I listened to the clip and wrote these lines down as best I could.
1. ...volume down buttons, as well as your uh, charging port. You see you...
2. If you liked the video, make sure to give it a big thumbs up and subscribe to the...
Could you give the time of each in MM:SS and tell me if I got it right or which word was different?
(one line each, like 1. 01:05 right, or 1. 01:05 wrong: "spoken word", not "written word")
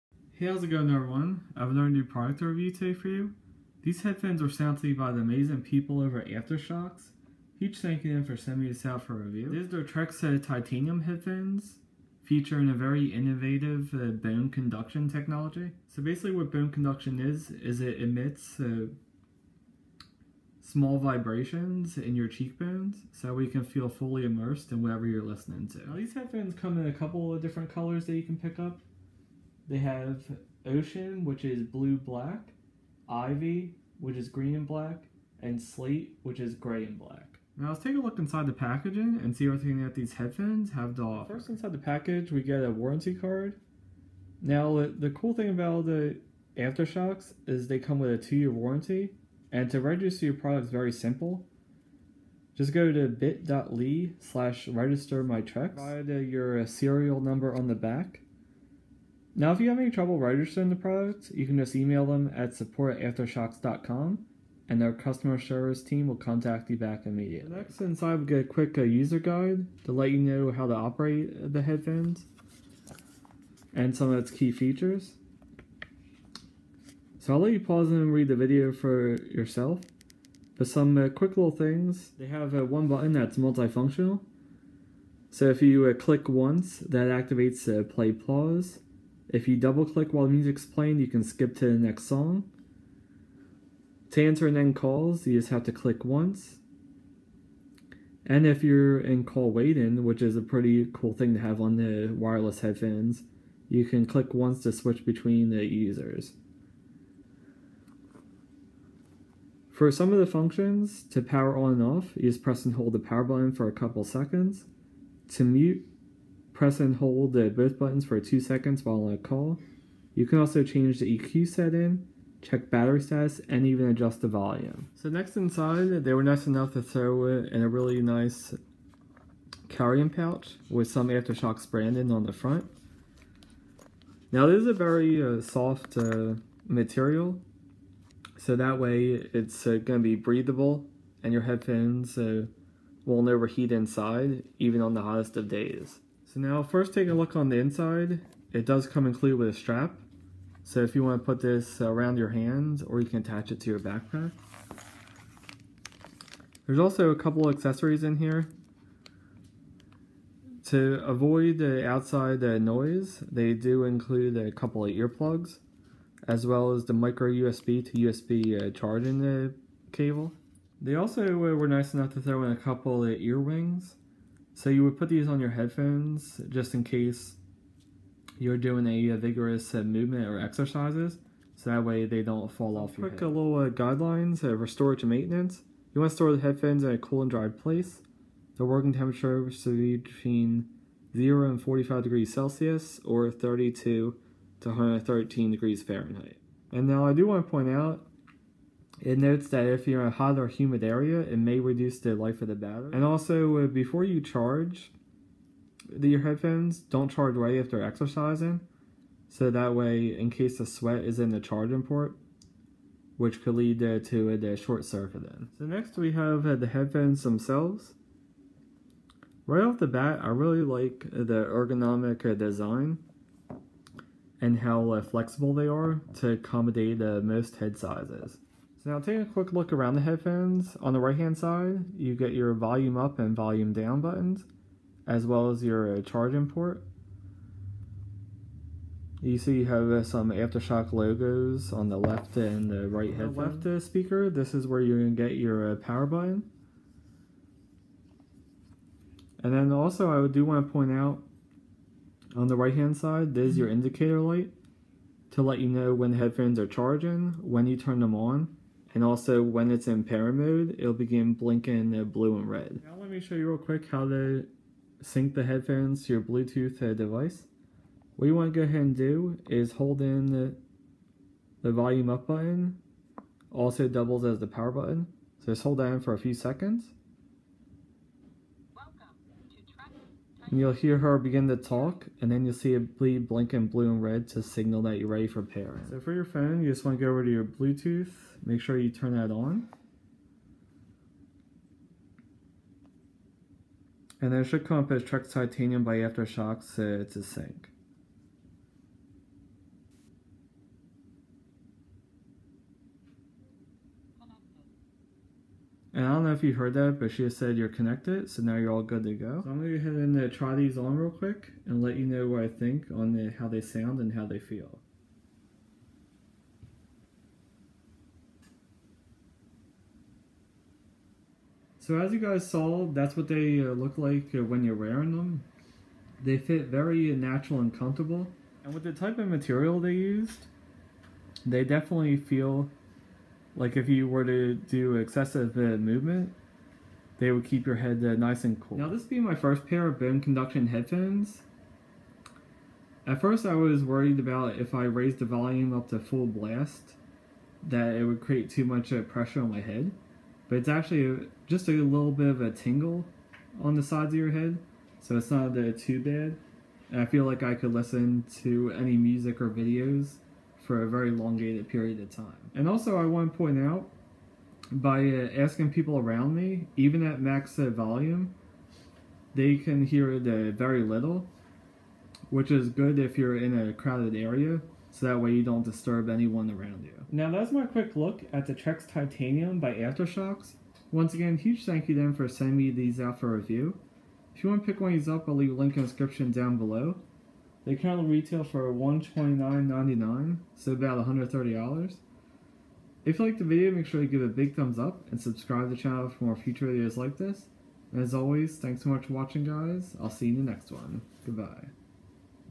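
1. 03:53 right
2. 06:33 right.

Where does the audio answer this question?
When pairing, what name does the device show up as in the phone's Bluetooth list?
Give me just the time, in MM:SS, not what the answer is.
04:55.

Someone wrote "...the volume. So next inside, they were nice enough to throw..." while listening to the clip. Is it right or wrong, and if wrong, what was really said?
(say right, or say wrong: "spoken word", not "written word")
right.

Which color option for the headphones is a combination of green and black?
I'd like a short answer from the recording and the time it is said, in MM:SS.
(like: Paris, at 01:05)
Ivy, at 00:33.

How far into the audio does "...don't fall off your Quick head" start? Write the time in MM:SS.
03:02.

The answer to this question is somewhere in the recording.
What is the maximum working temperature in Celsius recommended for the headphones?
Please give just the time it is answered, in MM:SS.
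03:11.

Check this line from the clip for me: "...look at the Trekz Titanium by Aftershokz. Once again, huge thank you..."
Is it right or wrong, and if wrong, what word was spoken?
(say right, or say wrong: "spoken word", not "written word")
right.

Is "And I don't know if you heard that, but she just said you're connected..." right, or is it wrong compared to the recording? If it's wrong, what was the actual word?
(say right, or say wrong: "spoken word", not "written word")
right.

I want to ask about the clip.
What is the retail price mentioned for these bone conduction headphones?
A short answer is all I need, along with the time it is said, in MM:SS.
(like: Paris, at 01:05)
$129.99, at 06:28.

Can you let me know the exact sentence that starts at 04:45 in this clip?
So for your phone, you just want to go over to your Bluetooth, make sure you turn that on.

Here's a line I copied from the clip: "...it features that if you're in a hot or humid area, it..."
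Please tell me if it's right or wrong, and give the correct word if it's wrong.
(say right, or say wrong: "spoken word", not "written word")
wrong: "notes", not "features".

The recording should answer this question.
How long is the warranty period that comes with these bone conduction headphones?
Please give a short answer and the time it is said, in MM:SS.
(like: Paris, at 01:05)
two-year, at 00:48.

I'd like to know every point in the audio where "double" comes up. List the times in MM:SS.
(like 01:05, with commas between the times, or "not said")
01:29, 04:33.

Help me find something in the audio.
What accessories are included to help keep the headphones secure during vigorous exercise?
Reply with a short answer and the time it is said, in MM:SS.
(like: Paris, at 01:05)
earwings, at 02:53.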